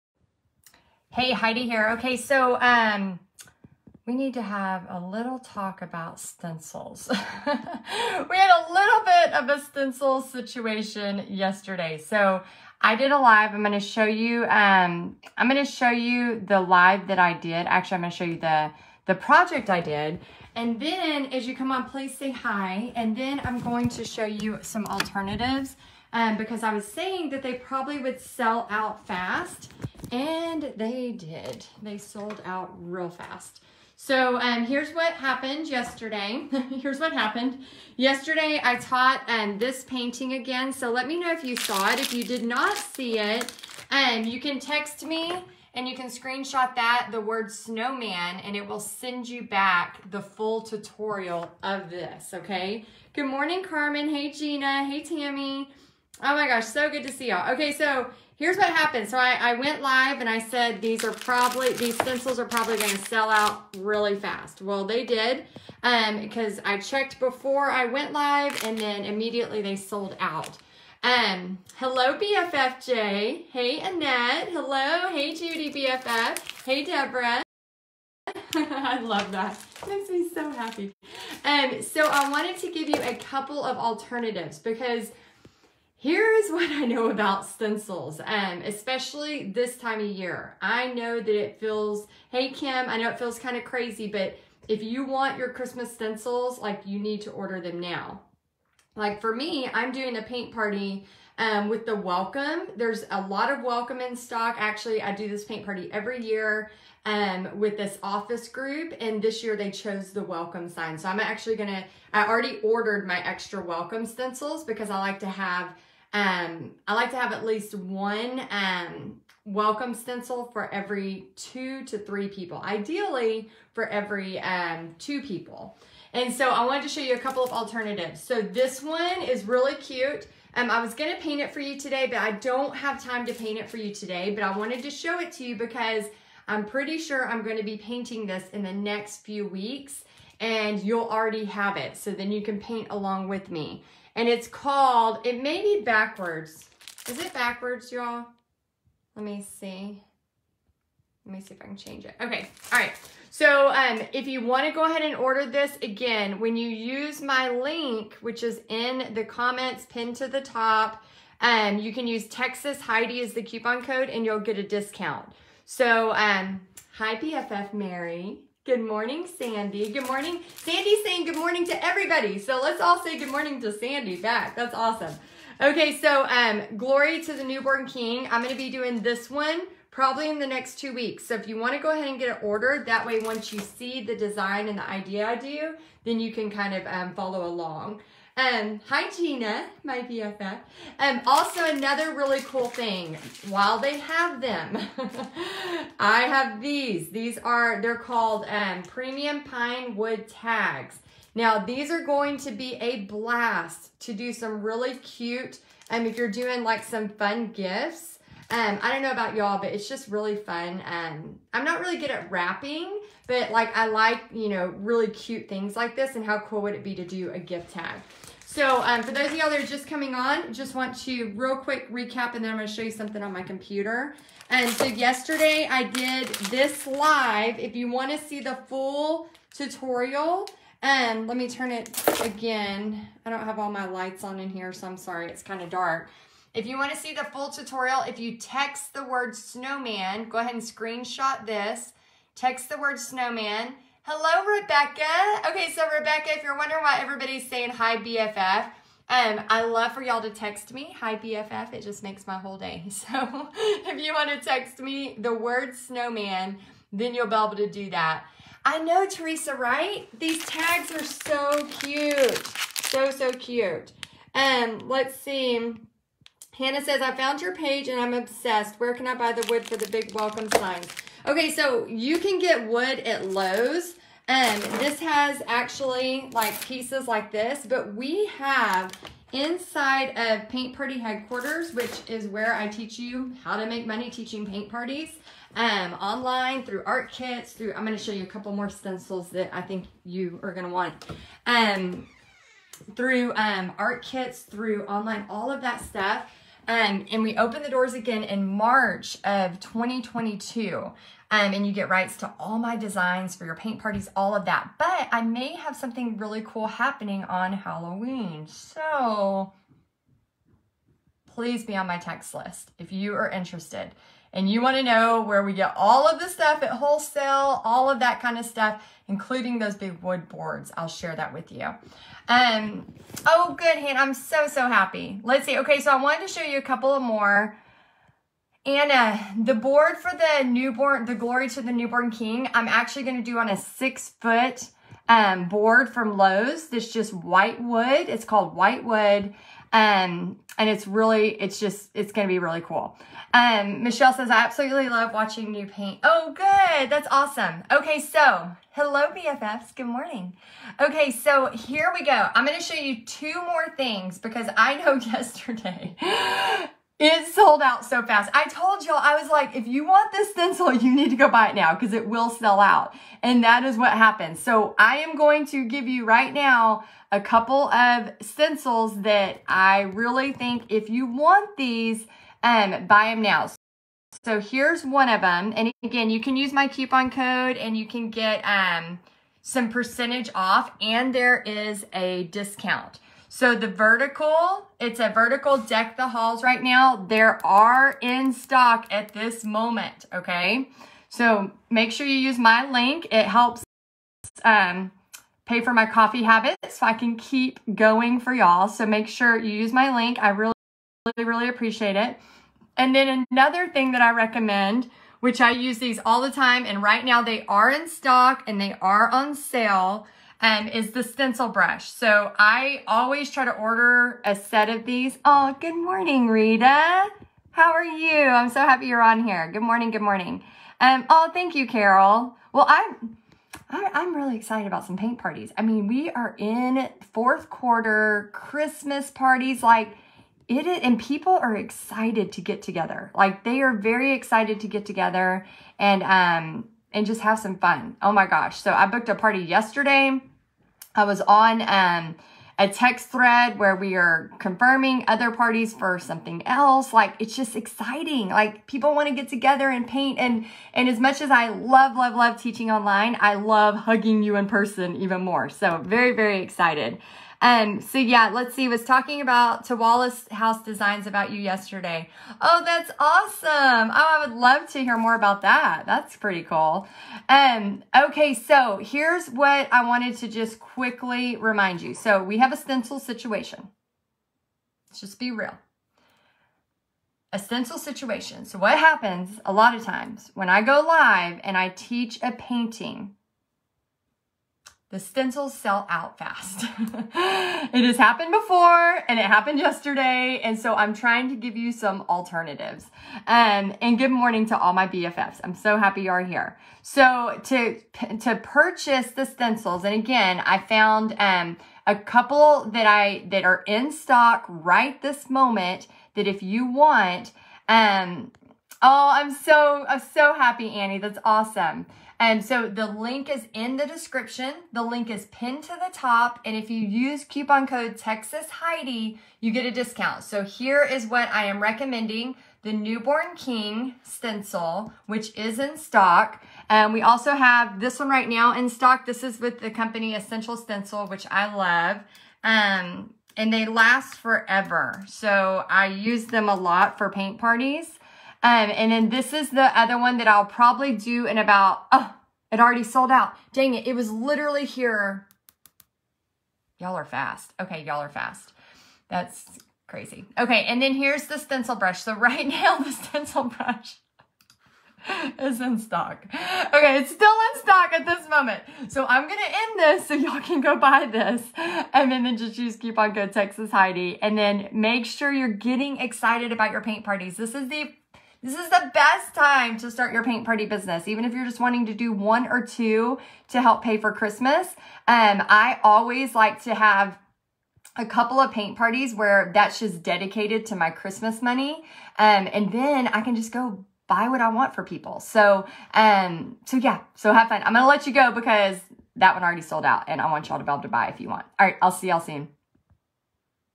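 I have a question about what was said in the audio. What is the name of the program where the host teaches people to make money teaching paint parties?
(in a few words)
Paint Party Headquarters.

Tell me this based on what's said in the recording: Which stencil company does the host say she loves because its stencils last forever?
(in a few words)
Essential Stencil.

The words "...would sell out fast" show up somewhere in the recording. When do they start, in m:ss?
0:27.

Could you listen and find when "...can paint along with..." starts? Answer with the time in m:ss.
2:22.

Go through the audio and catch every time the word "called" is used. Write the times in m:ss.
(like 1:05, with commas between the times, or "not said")
2:24, 3:17, 5:38.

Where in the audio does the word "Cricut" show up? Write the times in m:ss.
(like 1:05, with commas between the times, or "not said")
not said.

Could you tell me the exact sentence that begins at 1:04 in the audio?
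Well, they did um, because I checked before I went live and then immediately they sold out.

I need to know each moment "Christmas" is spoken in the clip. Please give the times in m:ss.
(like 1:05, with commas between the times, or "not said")
1:35, 7:08, 9:34, 9:40.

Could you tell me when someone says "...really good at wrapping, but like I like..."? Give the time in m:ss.
3:31.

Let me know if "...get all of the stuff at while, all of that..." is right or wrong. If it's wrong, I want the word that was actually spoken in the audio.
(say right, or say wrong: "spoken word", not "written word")
wrong: "wholesale", not "while".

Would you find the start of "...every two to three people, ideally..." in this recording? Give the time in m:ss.
2:00.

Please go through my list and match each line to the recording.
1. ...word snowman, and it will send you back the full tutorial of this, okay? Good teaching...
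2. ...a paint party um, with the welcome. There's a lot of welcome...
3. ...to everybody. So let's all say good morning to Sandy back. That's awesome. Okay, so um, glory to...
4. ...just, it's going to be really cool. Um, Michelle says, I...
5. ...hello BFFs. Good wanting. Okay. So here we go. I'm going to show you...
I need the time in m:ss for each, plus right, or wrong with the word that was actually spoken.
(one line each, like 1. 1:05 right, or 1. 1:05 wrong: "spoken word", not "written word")
1. 0:47 wrong: "morning", not "teaching"
2. 1:40 right
3. 2:51 right
4. 5:41 right
5. 5:48 wrong: "morning", not "wanting".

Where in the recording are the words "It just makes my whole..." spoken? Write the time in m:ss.
4:11.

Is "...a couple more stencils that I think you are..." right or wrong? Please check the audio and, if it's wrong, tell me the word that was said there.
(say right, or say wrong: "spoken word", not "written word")
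right.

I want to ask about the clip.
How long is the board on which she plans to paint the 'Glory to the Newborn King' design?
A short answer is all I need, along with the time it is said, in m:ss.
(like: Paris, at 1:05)
6 feet, at 5:33.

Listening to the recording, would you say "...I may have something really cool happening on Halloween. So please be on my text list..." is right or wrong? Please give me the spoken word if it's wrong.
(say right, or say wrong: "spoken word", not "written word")
right.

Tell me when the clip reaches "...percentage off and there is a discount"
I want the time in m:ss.
6:19.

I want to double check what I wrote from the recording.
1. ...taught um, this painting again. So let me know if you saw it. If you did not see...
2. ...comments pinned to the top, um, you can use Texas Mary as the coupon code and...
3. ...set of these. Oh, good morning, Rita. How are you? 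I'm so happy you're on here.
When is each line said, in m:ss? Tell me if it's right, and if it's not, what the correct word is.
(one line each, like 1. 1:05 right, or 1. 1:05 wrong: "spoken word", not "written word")
1. 0:38 right
2. 2:39 wrong: "Heidi", not "Mary"
3. 6:54 right.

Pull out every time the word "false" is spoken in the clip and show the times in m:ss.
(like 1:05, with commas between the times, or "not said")
not said.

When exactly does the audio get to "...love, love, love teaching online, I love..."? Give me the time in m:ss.
7:31.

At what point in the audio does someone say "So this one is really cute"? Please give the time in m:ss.
2:08.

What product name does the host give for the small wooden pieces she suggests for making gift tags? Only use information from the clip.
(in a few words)
Premium Pine Wood Tags.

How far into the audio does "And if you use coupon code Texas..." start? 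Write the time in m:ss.
8:36.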